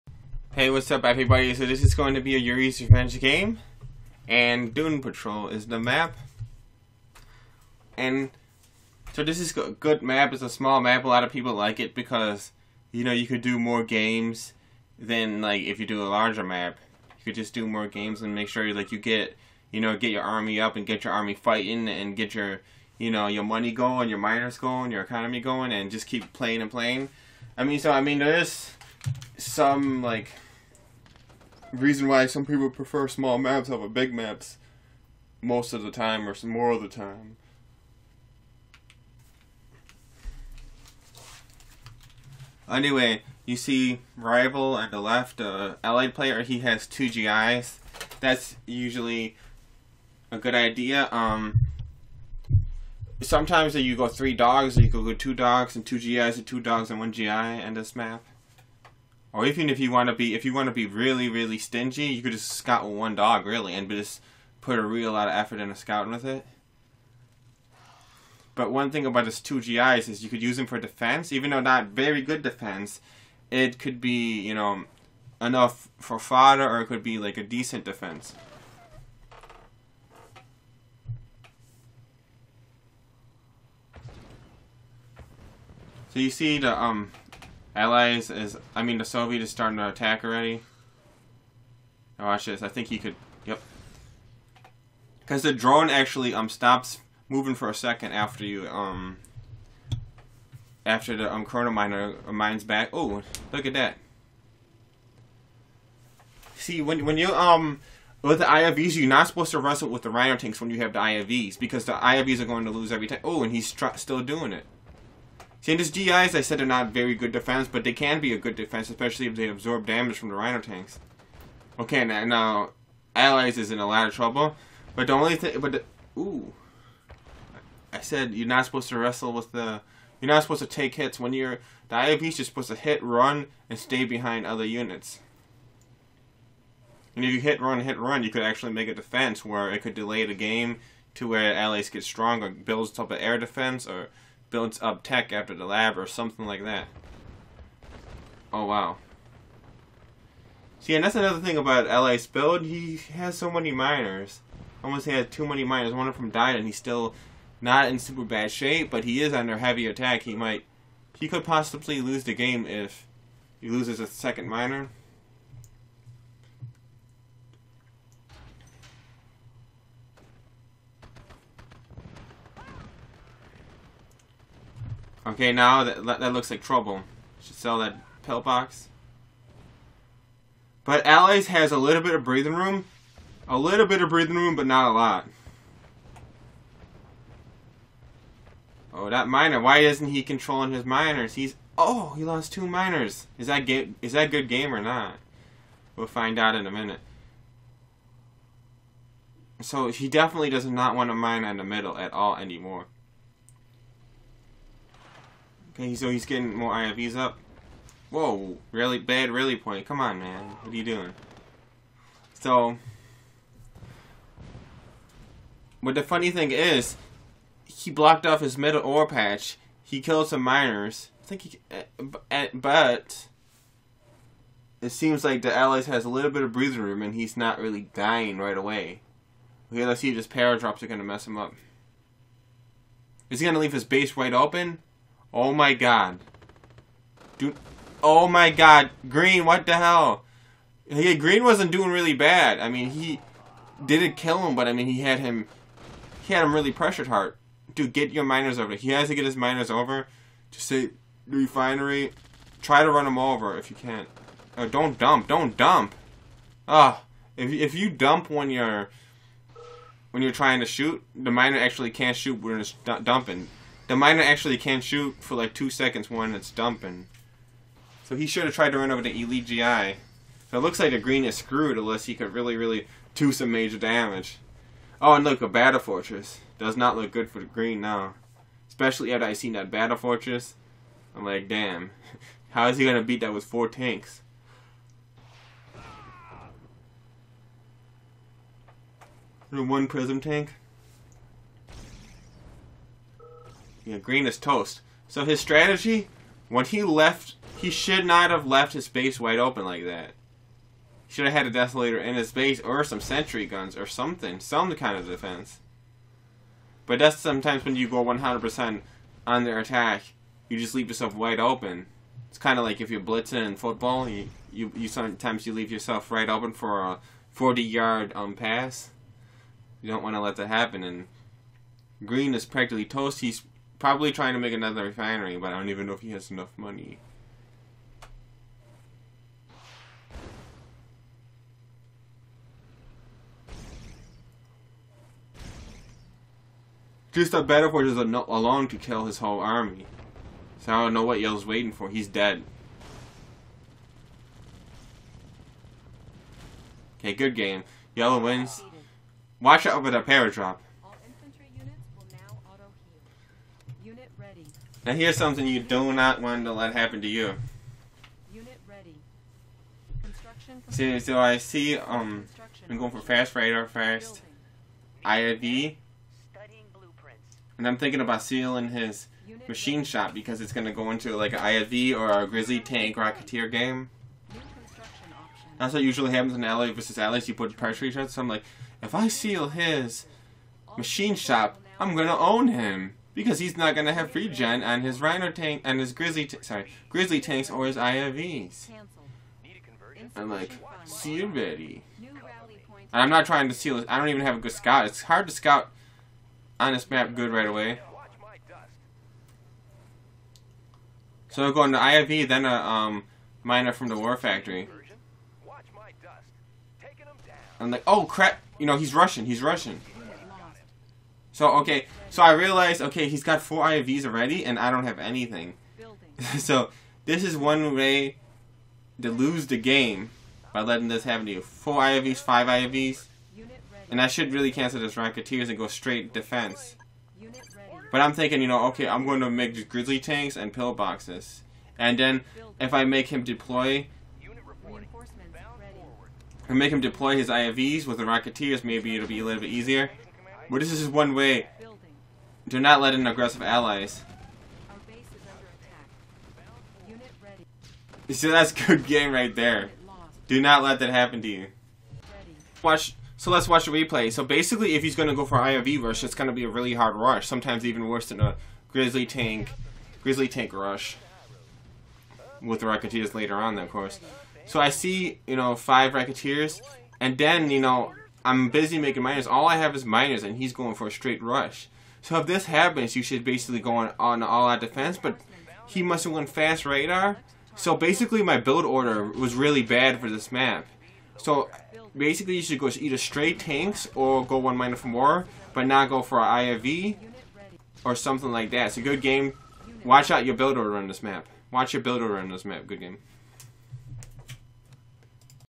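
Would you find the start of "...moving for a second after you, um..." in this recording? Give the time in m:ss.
1:37.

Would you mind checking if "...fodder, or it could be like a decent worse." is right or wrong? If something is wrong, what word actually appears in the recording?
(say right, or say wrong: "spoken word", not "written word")
wrong: "defense", not "worse".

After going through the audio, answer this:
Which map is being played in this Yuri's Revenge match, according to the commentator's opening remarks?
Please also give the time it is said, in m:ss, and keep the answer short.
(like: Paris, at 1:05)
Dune Patrol, at 0:04.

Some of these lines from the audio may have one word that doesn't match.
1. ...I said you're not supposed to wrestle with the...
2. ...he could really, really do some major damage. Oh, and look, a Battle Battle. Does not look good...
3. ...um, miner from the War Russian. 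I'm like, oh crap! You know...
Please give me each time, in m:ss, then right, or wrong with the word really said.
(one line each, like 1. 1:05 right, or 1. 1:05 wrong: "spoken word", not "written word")
1. 2:07 right
2. 4:32 wrong: "Fortress", not "Battle"
3. 6:42 wrong: "Factory", not "Russian".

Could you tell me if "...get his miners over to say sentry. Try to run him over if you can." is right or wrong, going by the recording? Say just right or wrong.
wrong.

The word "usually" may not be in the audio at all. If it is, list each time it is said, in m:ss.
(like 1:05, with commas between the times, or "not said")
0:48, 6:15.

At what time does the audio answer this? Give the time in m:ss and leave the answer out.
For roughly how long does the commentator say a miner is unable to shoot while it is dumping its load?
4:25.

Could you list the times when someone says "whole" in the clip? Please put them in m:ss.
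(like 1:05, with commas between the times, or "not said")
5:39.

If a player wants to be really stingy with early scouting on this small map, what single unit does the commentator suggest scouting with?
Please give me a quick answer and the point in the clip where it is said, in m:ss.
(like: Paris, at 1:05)
one dog, at 1:02.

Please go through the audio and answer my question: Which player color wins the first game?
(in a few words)
Yellow.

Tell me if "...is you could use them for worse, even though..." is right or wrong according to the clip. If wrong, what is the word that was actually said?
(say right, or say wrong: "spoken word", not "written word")
wrong: "defense", not "worse".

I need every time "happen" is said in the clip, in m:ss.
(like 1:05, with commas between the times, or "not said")
5:20, 5:56, 6:16, 7:01, 7:30, 7:52.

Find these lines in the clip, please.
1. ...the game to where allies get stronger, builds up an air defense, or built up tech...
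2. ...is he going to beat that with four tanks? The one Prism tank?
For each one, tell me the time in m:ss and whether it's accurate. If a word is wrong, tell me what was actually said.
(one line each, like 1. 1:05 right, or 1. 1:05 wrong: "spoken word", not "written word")
1. 2:20 right
2. 4:42 right.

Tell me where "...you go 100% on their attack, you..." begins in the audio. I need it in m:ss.
5:07.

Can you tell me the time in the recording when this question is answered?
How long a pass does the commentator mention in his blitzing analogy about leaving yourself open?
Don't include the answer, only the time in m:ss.
5:17.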